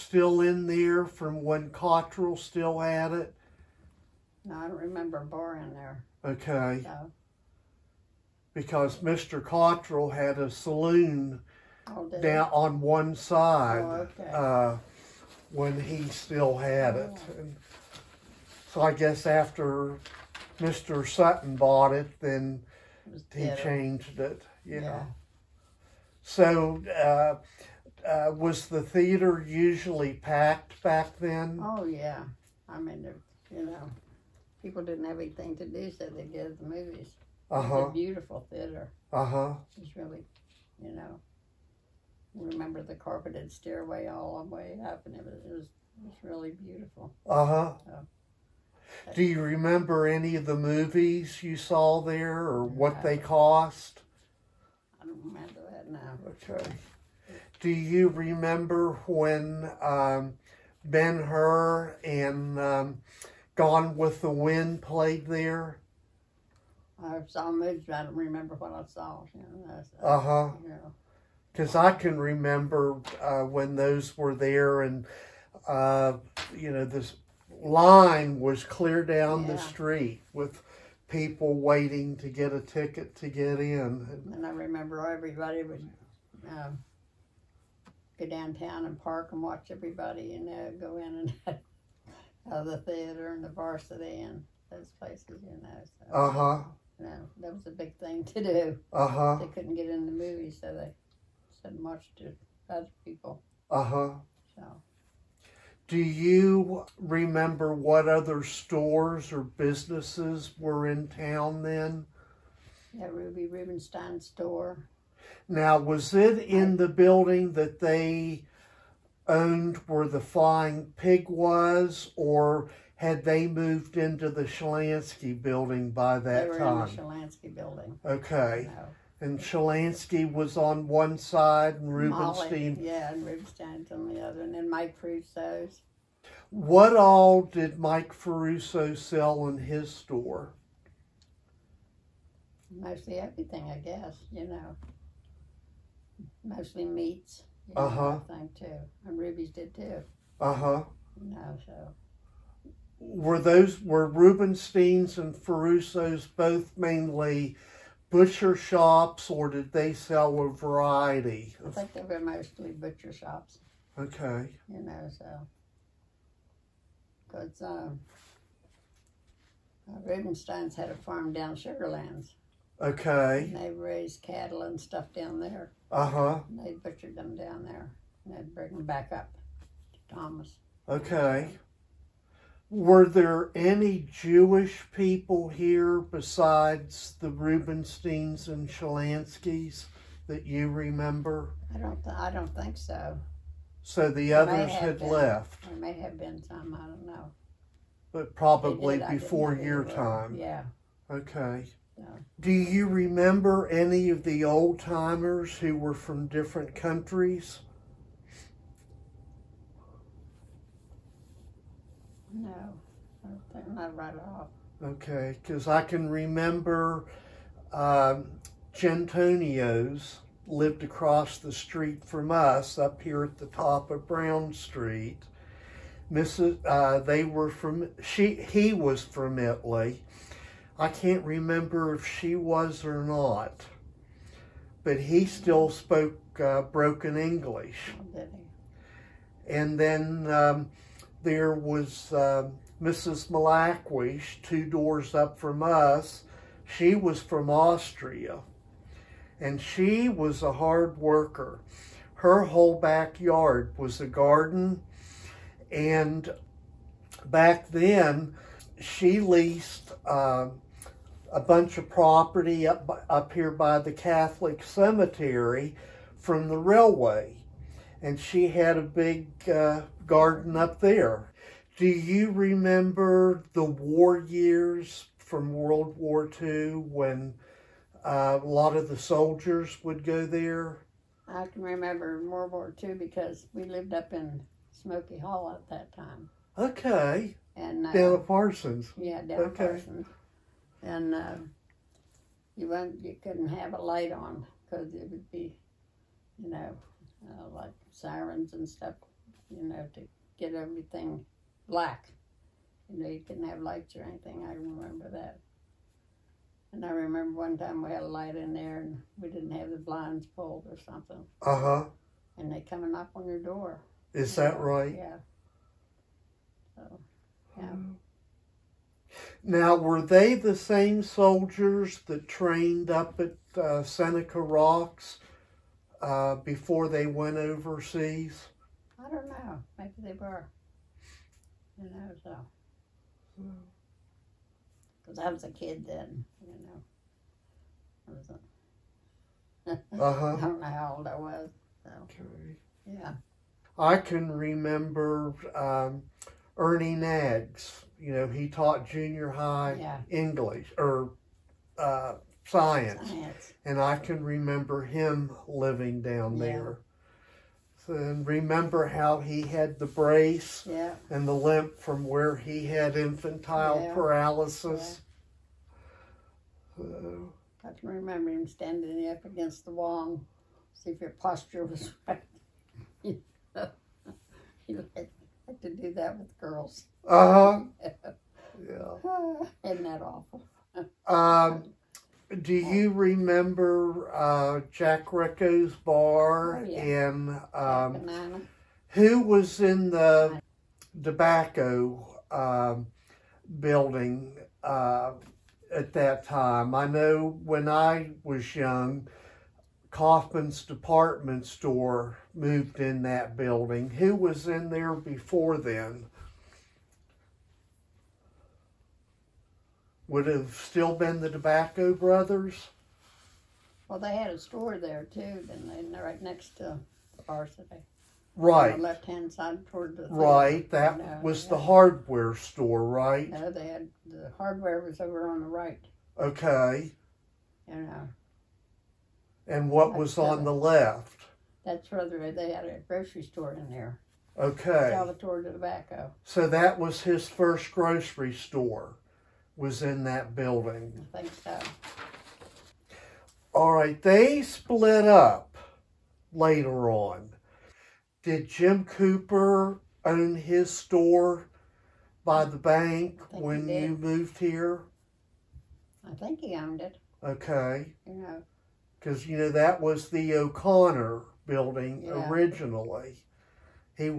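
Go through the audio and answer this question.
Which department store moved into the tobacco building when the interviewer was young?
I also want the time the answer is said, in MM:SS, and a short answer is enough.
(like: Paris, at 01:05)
Kaufman's, at 06:39.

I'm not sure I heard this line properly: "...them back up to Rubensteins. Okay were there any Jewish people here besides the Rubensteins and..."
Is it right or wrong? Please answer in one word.
wrong.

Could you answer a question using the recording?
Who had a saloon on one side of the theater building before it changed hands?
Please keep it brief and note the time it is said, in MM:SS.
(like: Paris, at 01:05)
Mr. Cottrell, at 00:08.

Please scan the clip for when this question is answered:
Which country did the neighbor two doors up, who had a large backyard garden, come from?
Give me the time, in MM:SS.
04:07.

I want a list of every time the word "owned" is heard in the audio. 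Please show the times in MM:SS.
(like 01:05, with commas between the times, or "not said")
01:59, 07:36.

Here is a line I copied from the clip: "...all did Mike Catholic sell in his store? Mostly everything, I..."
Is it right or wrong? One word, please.
wrong.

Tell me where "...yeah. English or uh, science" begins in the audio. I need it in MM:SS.
05:49.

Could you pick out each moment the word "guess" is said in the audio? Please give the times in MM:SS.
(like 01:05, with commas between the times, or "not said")
00:18, 02:23.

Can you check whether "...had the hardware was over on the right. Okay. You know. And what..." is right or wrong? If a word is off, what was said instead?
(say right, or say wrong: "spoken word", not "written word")
right.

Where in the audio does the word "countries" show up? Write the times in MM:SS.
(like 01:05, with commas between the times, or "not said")
03:26.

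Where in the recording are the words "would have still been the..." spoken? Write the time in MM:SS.
06:50.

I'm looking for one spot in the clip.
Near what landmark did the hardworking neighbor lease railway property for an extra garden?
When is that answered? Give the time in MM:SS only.
04:23.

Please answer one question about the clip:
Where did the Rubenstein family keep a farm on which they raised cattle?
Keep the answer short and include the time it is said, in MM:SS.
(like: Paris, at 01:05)
Sugarlands, at 02:51.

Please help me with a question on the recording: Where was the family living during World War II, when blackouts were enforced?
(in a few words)
Smoky Hall.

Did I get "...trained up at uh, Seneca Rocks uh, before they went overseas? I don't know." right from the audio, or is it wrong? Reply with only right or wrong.
right.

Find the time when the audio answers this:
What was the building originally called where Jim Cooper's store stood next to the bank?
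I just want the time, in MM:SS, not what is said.
07:40.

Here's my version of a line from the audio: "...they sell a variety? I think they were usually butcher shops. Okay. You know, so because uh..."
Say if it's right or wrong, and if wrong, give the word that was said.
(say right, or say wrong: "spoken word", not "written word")
wrong: "mostly", not "usually".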